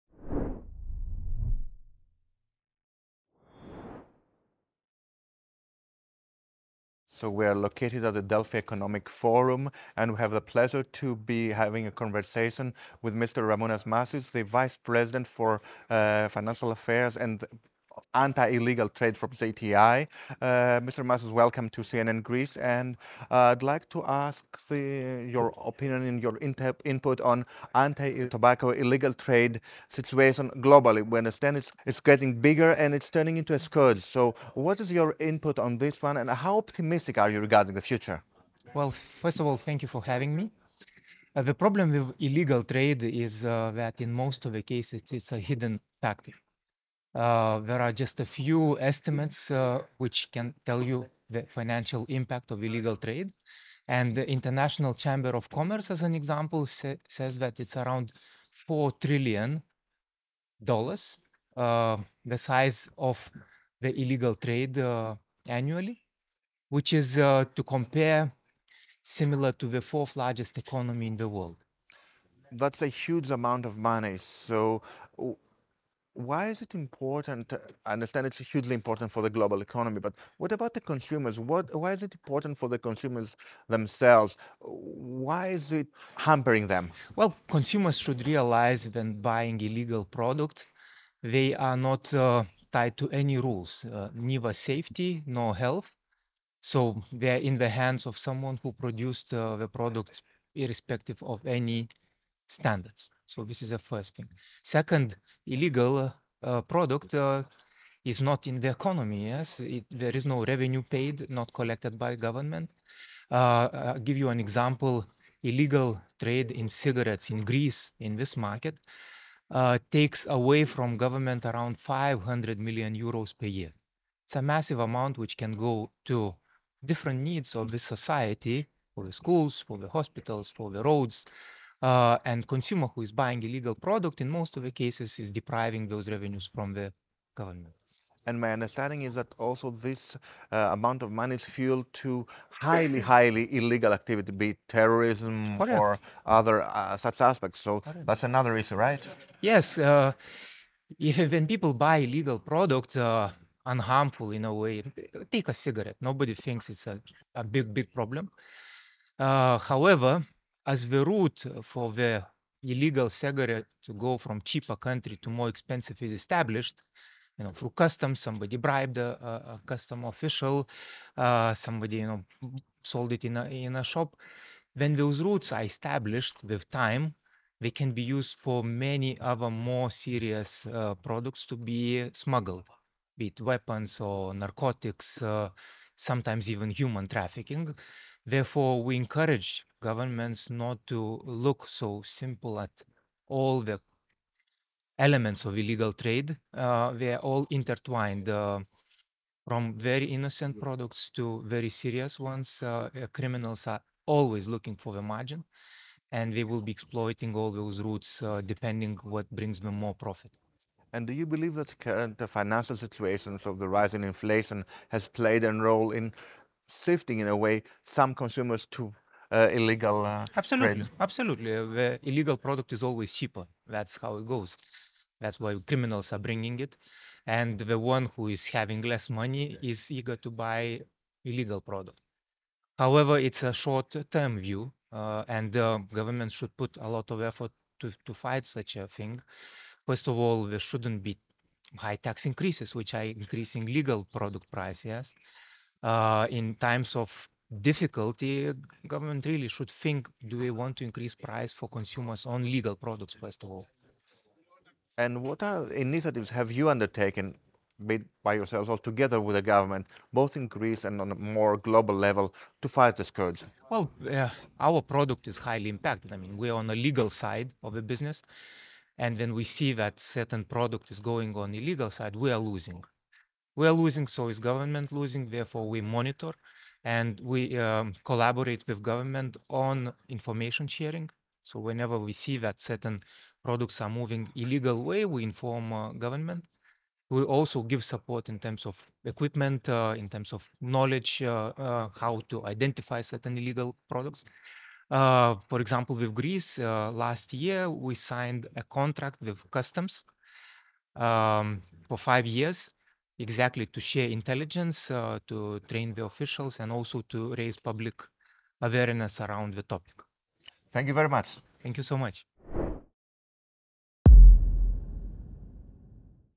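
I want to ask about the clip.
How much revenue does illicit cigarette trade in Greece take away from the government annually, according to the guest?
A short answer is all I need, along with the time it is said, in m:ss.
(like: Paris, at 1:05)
500 million euros, at 2:01.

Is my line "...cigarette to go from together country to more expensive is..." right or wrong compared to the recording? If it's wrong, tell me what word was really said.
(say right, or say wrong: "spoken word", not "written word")
wrong: "cheaper", not "together".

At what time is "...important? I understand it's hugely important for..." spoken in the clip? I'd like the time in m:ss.
1:16.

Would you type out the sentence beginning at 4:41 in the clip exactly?
So whenever we see that certain products are moving illegal way, we inform uh, government.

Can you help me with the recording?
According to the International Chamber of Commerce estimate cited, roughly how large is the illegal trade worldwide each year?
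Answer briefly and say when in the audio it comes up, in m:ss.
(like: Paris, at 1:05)
$4 trillion, at 0:58.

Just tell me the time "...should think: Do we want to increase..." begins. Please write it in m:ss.
4:09.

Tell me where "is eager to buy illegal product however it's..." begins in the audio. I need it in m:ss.
3:49.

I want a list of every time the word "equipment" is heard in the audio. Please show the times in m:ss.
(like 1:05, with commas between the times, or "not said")
4:49.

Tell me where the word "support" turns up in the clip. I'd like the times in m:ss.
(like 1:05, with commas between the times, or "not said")
4:47.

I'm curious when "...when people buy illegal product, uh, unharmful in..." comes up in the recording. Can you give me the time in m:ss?
2:31.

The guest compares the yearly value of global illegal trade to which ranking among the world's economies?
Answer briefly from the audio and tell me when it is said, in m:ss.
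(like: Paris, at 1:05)
fourth largest, at 1:09.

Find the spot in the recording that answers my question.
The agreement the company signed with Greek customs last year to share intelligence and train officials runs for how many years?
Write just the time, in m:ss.
5:01.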